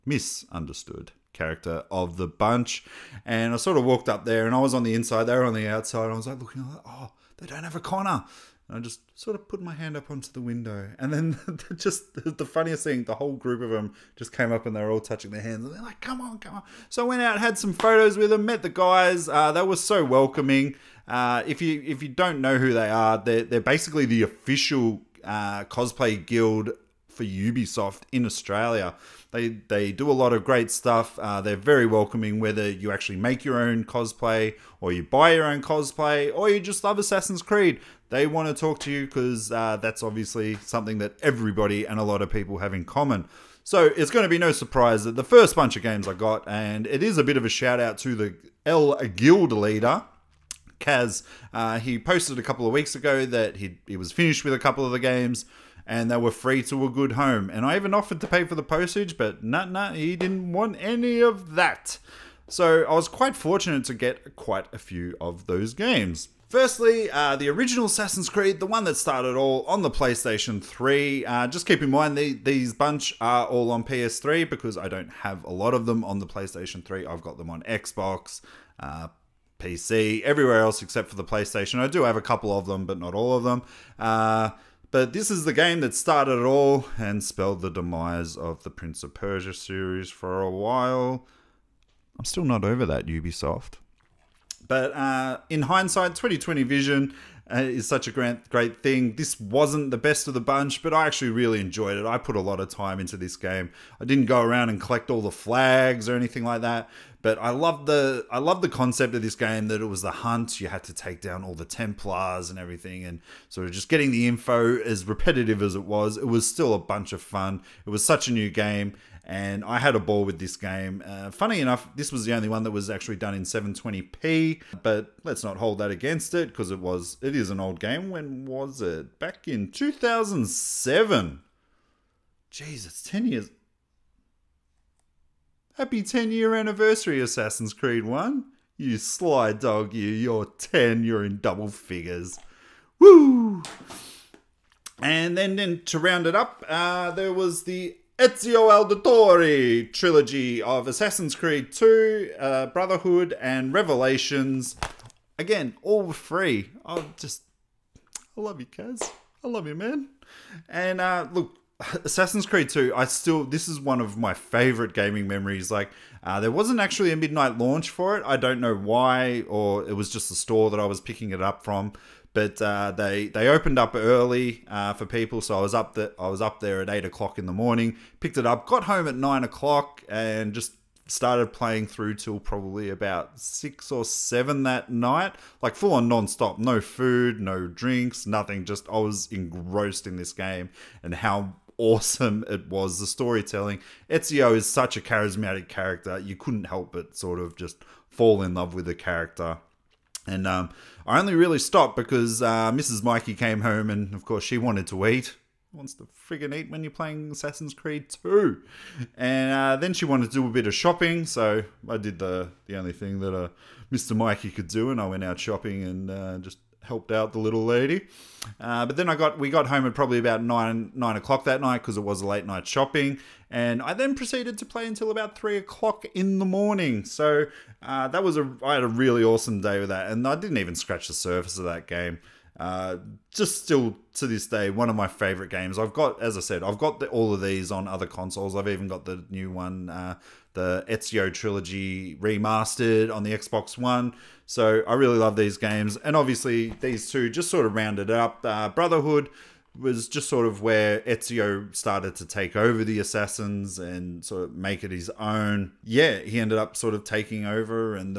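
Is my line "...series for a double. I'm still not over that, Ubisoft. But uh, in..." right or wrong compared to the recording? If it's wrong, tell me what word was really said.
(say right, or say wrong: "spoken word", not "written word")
wrong: "while", not "double".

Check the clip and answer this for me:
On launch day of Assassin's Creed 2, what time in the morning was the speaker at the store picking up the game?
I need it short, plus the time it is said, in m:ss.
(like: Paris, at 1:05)
8 o'clock, at 2:56.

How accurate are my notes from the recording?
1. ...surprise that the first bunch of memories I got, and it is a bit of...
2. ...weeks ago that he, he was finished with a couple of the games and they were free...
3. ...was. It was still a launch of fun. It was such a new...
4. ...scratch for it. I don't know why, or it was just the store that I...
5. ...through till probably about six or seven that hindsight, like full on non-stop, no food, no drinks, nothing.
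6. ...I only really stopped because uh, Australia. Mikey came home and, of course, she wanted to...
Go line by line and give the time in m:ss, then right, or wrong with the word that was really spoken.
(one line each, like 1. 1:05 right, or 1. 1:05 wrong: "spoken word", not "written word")
1. 0:44 wrong: "games", not "memories"
2. 0:52 right
3. 1:55 wrong: "bunch", not "launch"
4. 2:47 wrong: "launch", not "scratch"
5. 3:01 wrong: "night", not "hindsight"
6. 3:21 wrong: "Mrs", not "Australia".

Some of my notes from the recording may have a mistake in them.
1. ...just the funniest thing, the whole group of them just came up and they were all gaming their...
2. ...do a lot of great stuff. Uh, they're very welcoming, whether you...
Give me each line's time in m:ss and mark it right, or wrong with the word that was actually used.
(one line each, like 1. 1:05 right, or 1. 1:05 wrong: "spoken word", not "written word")
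1. 0:11 wrong: "touching", not "gaming"
2. 0:29 right.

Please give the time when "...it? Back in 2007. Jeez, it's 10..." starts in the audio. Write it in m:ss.
2:08.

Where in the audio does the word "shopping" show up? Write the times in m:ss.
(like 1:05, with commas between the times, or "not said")
3:30, 3:35, 3:42.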